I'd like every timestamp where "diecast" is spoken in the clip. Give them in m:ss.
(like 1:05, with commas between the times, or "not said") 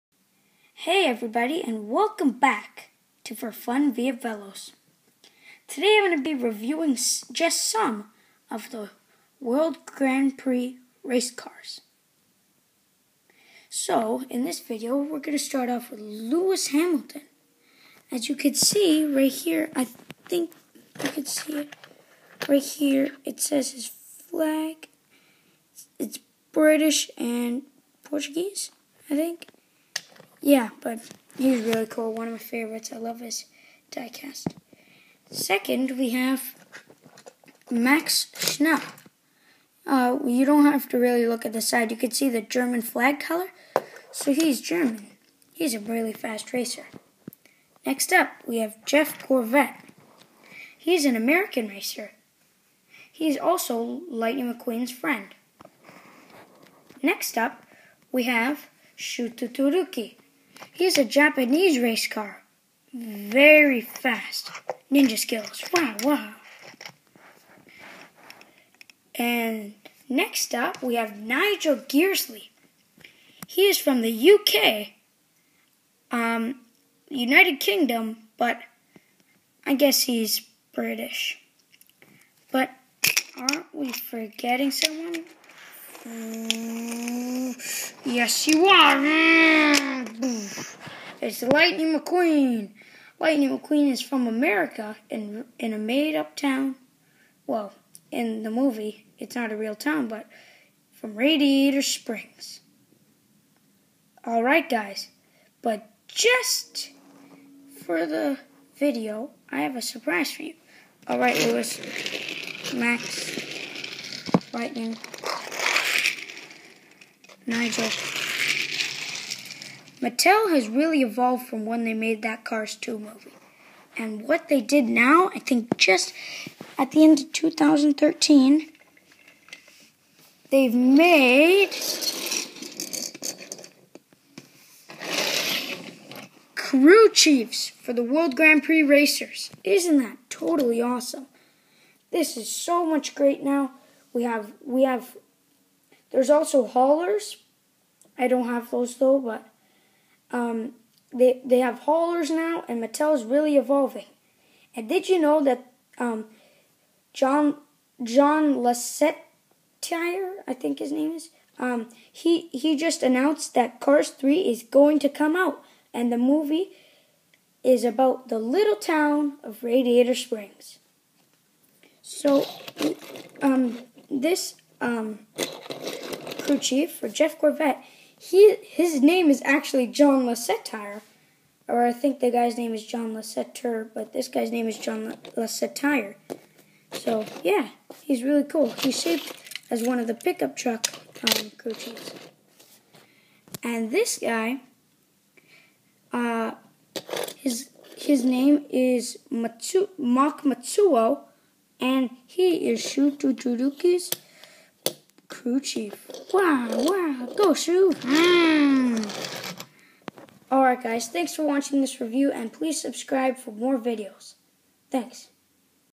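0:33.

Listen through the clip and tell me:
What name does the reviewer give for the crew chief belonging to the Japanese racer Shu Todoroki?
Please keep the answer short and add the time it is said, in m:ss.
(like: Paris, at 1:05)
Mark Matsuo, at 3:19.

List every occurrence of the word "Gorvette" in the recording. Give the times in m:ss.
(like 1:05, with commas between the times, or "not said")
0:49, 2:57.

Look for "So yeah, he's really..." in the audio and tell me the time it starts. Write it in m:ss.
3:06.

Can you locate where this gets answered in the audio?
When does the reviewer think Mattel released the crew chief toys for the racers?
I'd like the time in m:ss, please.
2:07.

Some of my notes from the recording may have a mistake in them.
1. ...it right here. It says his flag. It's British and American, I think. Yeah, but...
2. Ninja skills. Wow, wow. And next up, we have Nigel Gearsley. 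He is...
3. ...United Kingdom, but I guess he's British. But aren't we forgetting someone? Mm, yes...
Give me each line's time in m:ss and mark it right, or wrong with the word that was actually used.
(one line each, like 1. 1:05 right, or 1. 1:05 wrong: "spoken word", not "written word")
1. 0:21 wrong: "Portuguese", not "American"
2. 1:04 right
3. 1:17 right.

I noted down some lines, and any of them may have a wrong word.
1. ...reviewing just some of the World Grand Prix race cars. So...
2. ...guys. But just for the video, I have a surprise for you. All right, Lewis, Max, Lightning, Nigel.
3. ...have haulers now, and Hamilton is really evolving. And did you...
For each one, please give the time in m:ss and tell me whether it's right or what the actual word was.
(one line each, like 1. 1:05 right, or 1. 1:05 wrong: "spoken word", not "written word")
1. 0:06 right
2. 1:44 right
3. 2:31 wrong: "Mattel", not "Hamilton".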